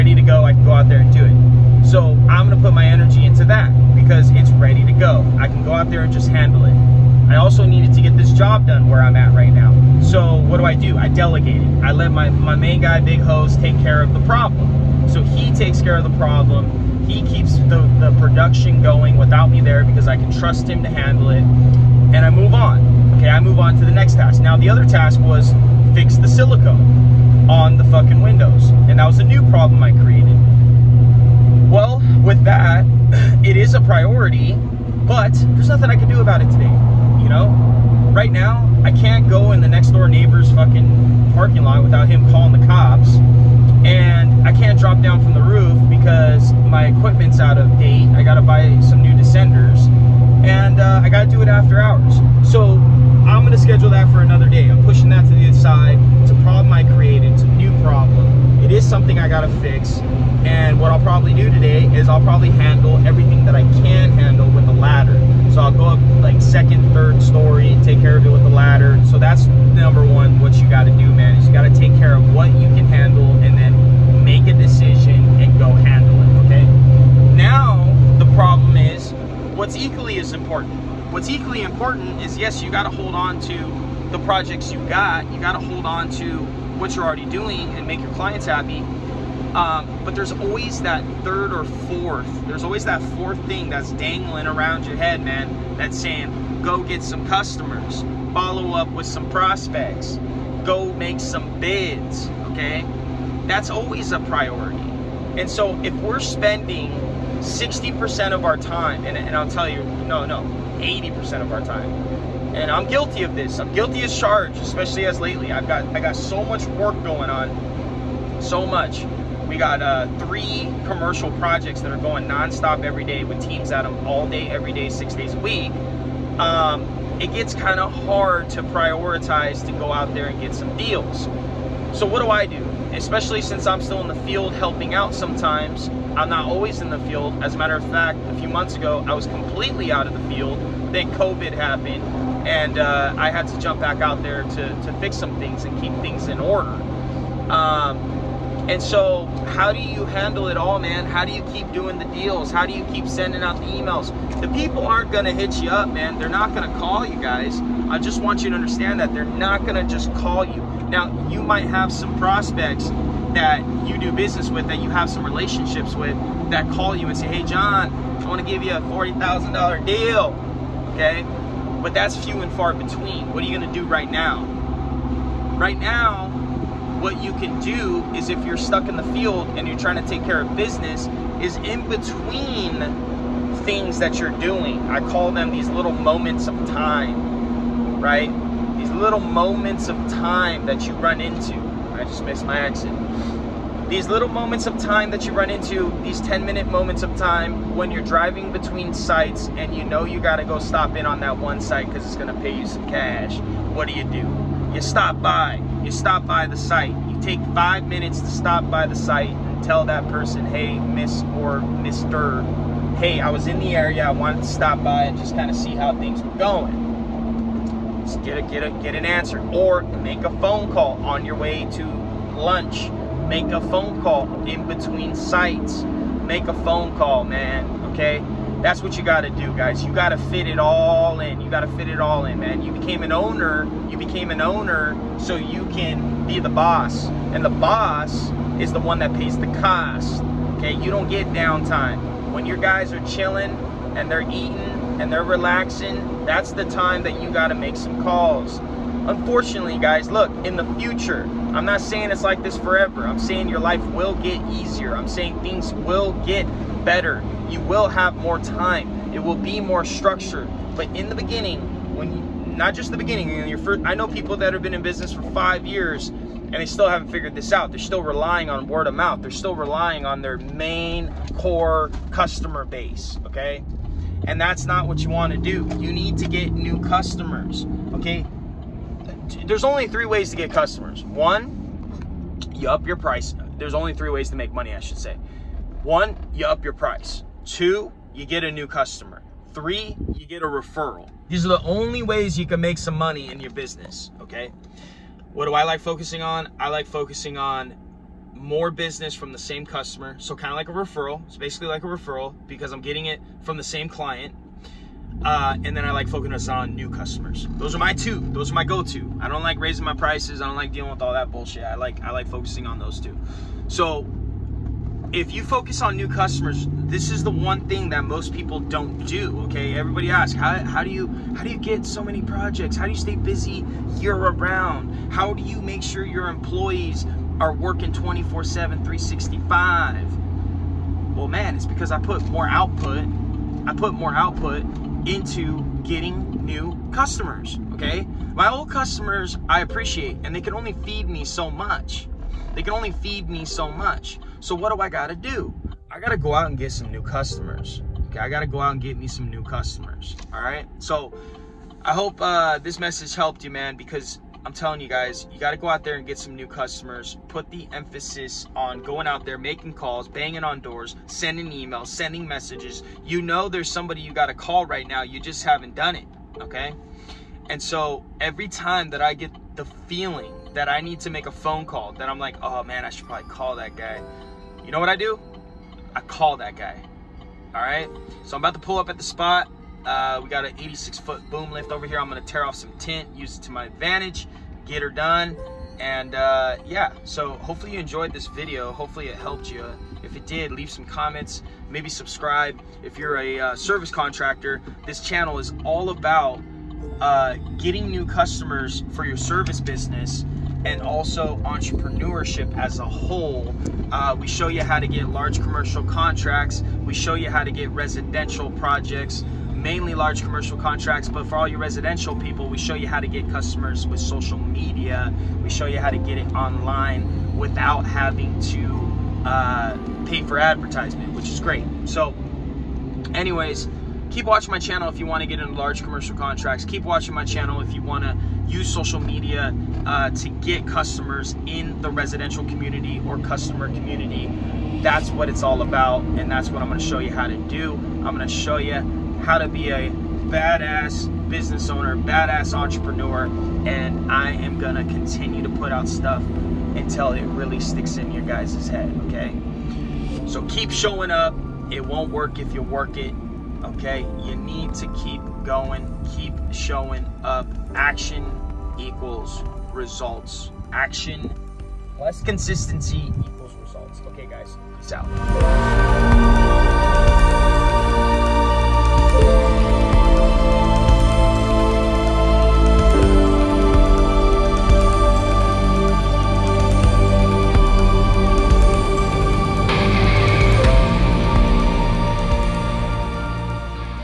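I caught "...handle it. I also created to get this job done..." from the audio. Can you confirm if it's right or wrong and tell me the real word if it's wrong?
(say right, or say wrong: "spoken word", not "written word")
wrong: "needed", not "created".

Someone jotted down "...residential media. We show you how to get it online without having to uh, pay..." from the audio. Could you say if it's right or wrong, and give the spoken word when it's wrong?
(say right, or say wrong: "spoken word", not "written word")
wrong: "social", not "residential".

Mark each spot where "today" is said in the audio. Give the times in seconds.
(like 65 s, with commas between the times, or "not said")
36 s, 61 s.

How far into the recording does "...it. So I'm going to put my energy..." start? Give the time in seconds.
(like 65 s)
1 s.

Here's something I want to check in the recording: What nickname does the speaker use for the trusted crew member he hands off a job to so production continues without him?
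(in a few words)
Big Hose.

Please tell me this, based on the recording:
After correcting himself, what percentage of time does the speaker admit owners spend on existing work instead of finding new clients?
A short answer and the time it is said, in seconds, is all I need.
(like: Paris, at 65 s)
80%, at 110 s.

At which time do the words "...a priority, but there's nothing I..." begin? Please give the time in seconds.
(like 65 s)
33 s.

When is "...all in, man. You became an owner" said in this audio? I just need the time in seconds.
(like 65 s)
231 s.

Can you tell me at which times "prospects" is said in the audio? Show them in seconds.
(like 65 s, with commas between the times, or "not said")
99 s, 162 s.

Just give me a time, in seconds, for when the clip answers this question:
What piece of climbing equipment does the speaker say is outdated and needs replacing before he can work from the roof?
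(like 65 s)
49 s.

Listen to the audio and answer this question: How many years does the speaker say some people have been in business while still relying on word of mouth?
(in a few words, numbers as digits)
5.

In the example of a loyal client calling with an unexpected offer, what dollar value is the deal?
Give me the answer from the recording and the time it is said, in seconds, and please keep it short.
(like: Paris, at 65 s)
$40,000, at 168 s.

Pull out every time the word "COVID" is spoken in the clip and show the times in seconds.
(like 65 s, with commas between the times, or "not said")
141 s.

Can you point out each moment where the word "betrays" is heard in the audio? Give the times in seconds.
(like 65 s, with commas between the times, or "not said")
not said.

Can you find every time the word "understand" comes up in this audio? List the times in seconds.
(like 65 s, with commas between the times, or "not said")
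158 s.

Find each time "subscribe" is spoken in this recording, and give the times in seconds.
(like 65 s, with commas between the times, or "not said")
391 s.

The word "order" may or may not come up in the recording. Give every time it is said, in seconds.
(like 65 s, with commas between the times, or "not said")
146 s.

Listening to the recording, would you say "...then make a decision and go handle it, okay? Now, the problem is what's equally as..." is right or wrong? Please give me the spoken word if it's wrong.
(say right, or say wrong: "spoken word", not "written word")
right.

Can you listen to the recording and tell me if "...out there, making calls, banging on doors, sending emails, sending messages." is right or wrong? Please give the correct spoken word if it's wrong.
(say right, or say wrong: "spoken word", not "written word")
right.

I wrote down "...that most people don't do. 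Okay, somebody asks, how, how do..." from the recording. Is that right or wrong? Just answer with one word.
wrong.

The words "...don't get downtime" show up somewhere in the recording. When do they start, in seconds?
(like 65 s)
240 s.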